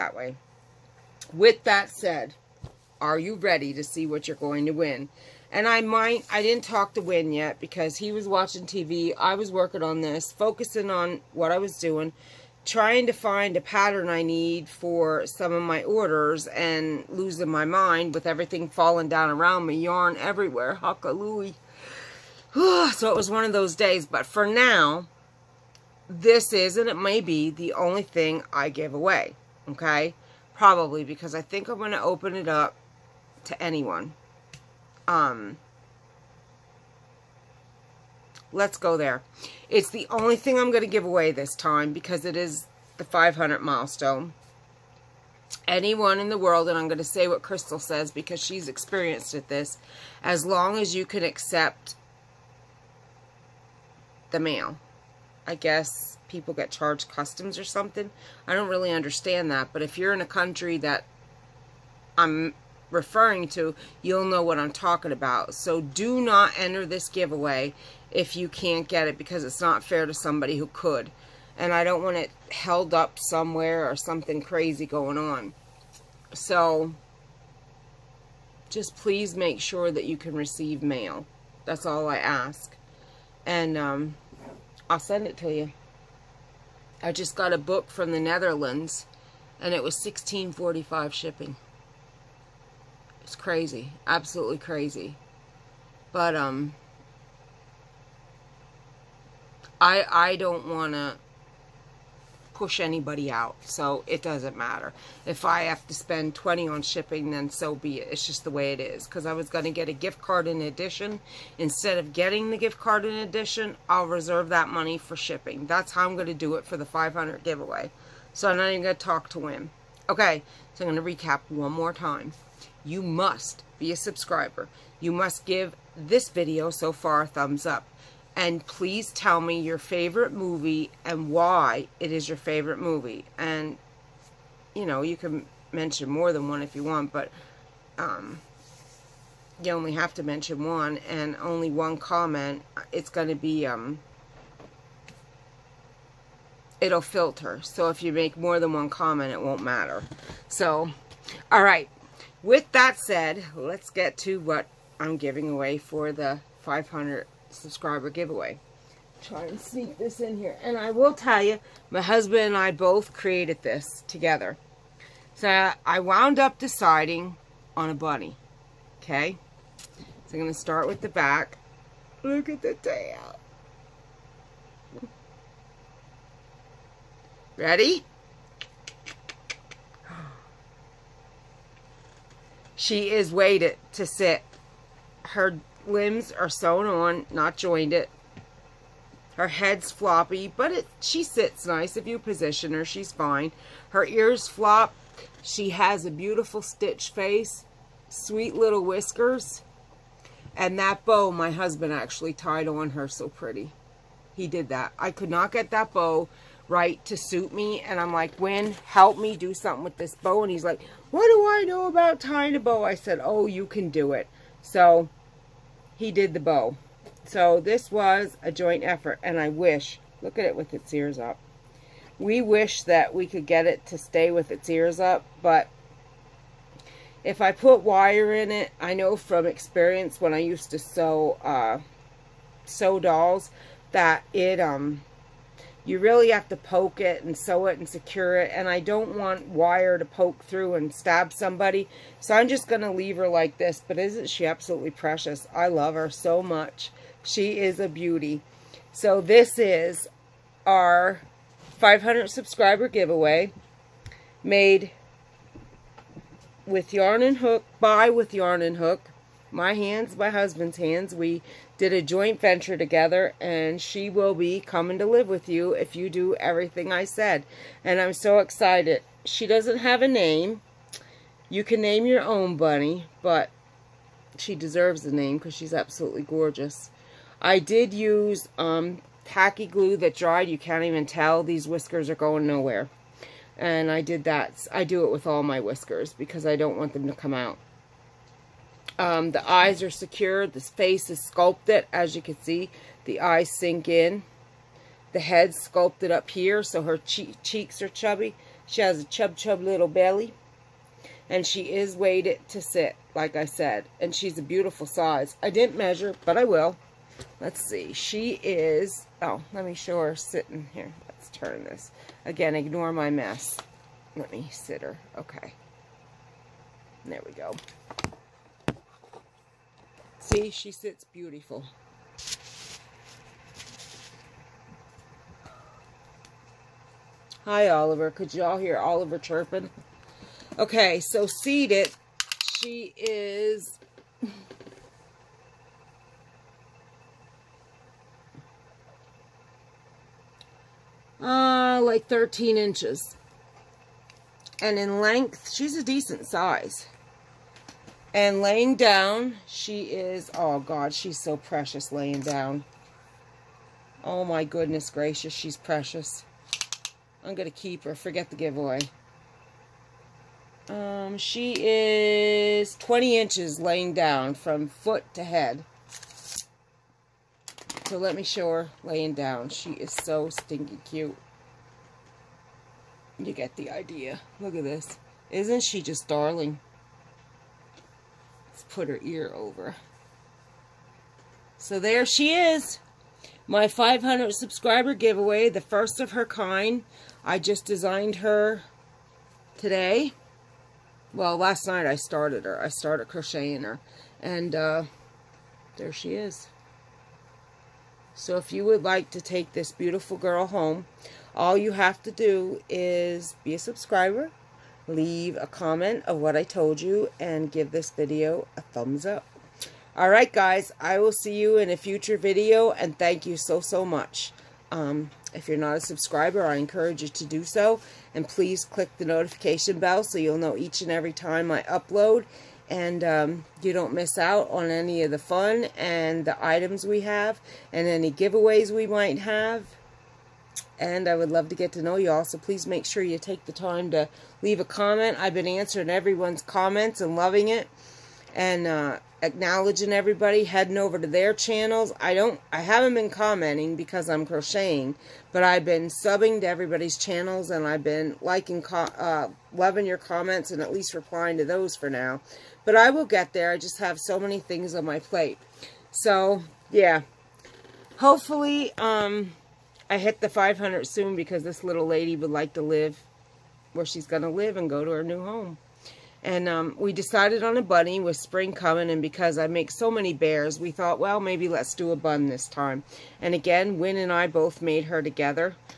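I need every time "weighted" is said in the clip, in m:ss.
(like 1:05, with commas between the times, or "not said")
3:03, 5:01.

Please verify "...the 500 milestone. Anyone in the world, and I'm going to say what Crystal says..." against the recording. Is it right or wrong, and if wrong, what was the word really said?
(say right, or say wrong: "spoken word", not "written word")
right.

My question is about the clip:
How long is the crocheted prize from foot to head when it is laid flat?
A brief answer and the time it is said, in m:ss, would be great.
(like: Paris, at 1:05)
20 inches, at 6:02.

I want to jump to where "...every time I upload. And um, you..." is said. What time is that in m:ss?
7:00.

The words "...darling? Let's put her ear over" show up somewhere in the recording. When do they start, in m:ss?
6:16.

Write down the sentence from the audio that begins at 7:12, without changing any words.
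So please make sure you take the time to leave a comment.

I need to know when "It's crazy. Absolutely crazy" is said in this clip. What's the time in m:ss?
1:33.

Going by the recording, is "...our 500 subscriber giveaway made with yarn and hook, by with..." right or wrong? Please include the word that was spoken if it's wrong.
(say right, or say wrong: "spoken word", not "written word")
right.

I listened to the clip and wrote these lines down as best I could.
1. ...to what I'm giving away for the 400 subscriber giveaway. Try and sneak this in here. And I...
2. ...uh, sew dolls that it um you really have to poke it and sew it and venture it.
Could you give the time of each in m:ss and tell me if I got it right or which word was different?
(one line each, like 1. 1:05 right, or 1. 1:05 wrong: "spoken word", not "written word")
1. 2:34 wrong: "500", not "400"
2. 3:51 wrong: "secure", not "venture".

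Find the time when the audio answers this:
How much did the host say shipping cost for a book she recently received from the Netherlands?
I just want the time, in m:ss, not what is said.
1:29.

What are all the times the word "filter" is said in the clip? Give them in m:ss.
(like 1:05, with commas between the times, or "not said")
2:27.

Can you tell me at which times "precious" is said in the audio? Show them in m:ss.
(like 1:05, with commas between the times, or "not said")
4:04, 5:51, 5:55.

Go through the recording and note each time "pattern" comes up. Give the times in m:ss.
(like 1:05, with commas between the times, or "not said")
0:13.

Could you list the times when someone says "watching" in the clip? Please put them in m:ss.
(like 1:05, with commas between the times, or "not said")
0:08.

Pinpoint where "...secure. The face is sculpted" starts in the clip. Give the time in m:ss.
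4:49.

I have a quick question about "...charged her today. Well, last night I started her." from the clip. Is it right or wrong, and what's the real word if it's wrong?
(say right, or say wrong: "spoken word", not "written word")
wrong: "designed", not "charged".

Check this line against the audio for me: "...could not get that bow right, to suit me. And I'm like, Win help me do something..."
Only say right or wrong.
right.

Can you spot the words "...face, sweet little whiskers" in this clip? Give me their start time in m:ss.
3:17.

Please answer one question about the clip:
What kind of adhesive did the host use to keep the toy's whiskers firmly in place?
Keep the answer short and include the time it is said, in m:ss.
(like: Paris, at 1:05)
tacky glue, at 4:39.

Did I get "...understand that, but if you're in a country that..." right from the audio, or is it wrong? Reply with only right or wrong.
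right.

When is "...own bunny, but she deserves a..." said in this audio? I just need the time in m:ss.
4:32.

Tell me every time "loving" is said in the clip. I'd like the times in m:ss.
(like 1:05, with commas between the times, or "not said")
7:17, 7:29.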